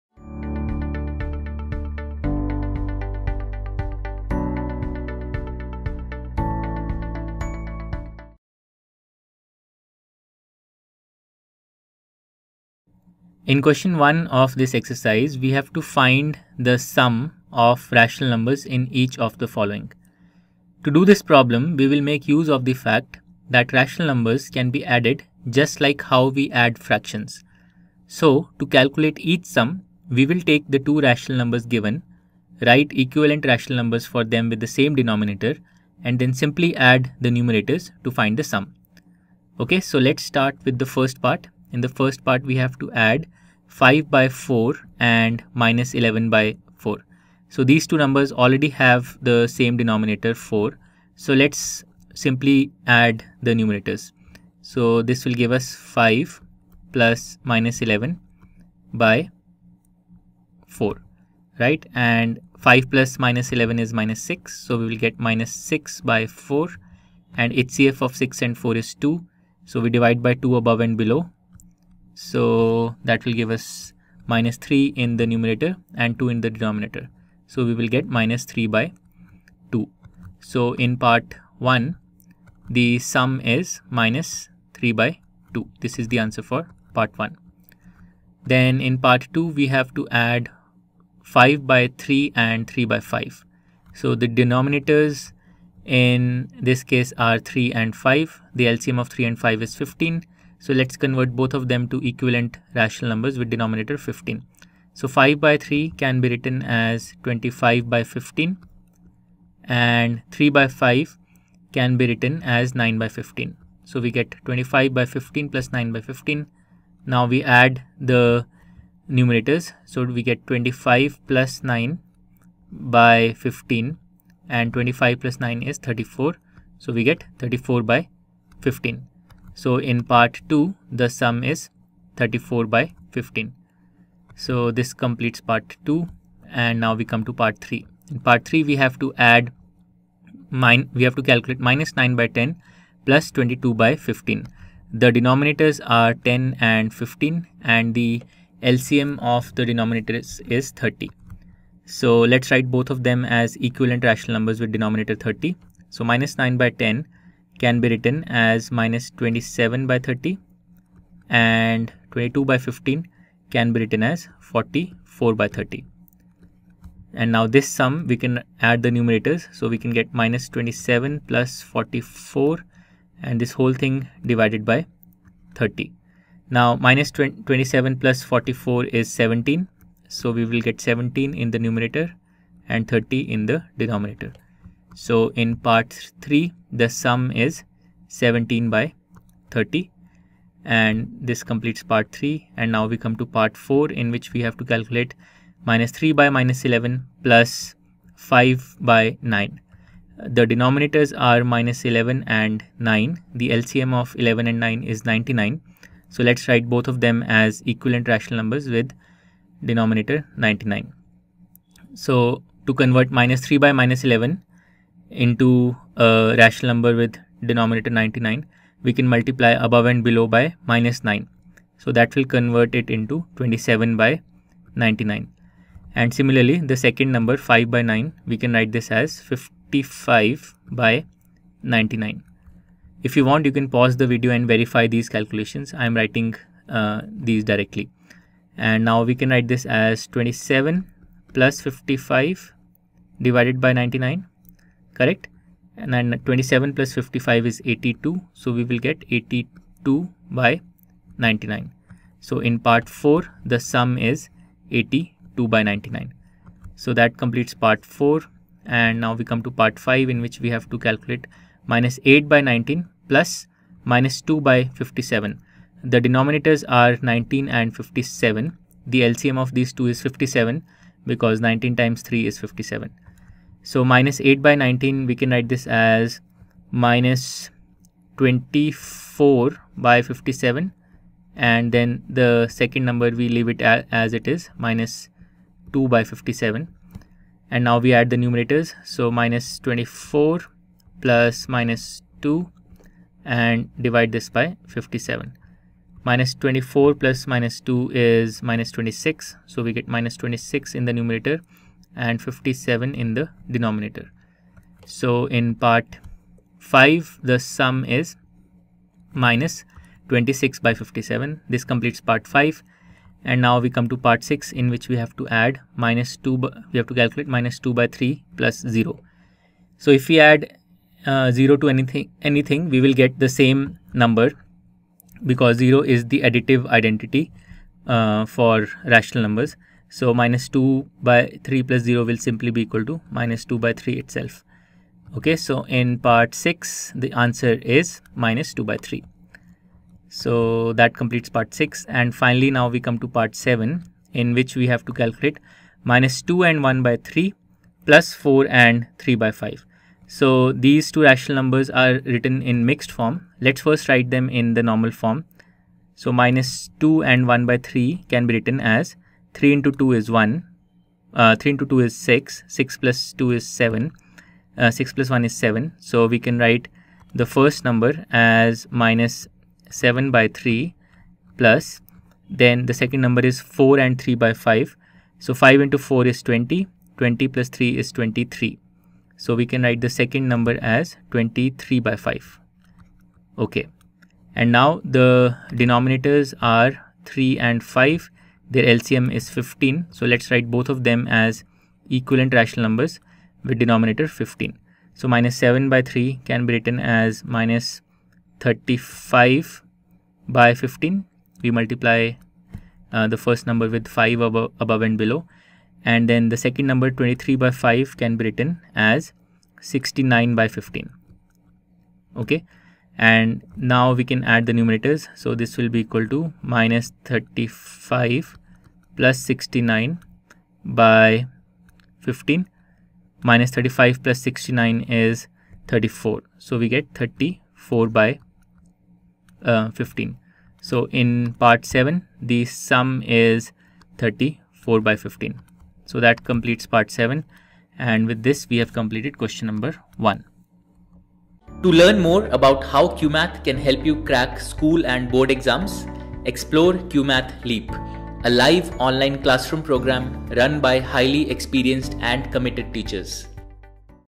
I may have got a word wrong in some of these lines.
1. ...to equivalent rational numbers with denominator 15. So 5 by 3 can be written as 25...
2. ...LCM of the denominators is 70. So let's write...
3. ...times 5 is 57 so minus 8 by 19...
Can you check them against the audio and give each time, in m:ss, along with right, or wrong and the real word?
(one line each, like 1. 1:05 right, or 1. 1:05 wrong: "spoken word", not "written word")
1. 1:41 right
2. 2:28 wrong: "30", not "70"
3. 4:31 wrong: "3", not "5".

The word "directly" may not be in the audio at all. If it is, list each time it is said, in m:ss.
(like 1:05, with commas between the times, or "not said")
3:57.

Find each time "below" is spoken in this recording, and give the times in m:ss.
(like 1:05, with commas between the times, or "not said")
1:10, 3:40, 6:44.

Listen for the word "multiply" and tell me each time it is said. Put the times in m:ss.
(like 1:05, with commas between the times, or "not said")
3:39, 6:41.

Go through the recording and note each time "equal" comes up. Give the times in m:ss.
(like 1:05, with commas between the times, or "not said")
5:32, 6:55.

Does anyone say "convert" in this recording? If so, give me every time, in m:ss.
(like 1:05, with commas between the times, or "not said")
1:40, 3:32, 3:42.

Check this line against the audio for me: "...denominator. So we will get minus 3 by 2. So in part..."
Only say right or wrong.
right.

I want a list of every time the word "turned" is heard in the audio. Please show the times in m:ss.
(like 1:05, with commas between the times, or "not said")
not said.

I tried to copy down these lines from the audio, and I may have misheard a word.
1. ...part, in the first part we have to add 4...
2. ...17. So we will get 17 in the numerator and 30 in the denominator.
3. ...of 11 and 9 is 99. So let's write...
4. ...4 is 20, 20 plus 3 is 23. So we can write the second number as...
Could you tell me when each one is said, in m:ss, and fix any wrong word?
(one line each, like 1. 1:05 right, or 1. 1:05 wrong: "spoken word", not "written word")
1. 0:41 wrong: "5", not "4"
2. 2:59 right
3. 3:23 right
4. 6:15 right.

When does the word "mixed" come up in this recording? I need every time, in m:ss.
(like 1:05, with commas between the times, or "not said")
5:52.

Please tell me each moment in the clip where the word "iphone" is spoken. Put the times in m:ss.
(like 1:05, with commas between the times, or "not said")
not said.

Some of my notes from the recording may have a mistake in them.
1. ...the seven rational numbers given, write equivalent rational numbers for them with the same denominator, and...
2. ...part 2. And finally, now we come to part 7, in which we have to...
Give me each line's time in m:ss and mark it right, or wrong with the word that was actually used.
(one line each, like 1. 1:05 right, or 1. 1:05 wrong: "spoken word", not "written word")
1. 0:30 wrong: "two", not "seven"
2. 5:41 wrong: "6", not "2".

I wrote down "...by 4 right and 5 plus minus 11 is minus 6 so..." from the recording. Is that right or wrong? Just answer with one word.
right.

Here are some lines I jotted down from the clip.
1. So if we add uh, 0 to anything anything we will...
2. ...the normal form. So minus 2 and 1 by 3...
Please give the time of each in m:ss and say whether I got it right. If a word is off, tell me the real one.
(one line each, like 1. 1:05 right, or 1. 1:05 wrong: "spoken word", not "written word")
1. 5:19 right
2. 5:54 right.